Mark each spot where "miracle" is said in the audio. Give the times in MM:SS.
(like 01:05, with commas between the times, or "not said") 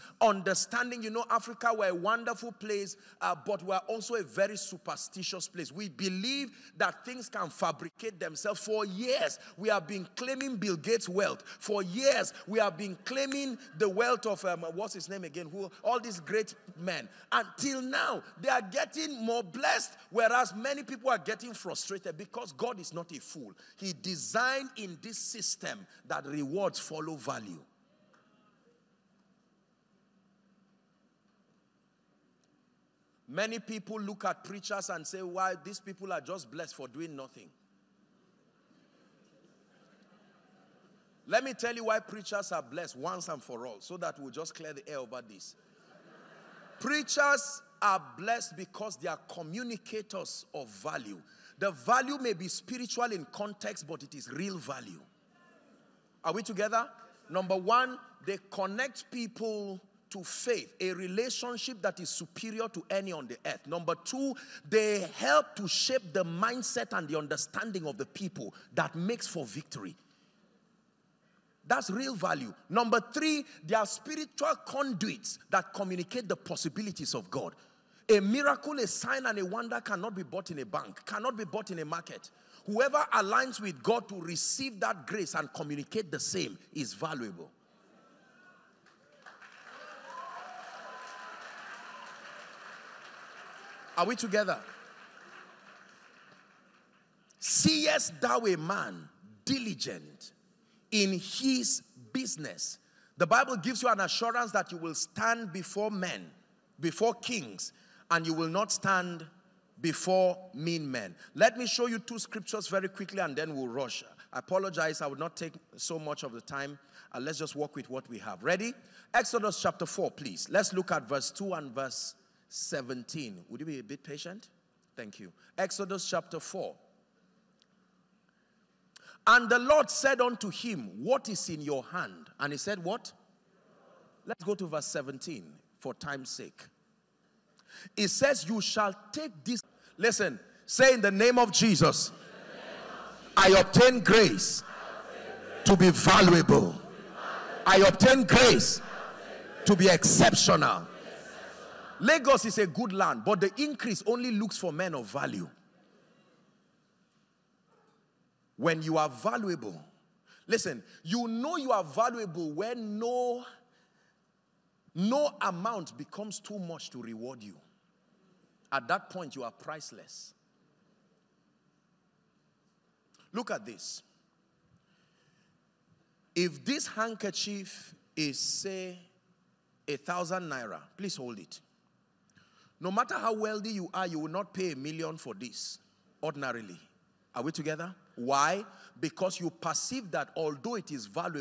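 01:18.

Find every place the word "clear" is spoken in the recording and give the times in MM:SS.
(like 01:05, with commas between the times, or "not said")
00:44.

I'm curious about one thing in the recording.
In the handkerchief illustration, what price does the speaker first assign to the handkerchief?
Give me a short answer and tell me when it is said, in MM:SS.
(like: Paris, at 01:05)
1,000 naira, at 02:59.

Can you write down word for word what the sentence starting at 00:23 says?
He designed in this system that rewards follow value.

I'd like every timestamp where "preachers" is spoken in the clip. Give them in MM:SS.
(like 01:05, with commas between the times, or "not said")
00:34, 00:41, 00:46.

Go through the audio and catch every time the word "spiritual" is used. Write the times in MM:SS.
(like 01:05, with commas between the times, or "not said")
00:52, 01:13.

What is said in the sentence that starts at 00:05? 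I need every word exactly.
We believe that things can fabricate themselves.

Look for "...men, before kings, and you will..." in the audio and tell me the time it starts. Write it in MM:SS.
01:45.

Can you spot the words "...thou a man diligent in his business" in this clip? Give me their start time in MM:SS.
01:38.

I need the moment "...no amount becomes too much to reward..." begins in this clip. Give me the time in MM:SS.
02:44.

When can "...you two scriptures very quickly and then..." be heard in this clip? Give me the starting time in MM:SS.
01:51.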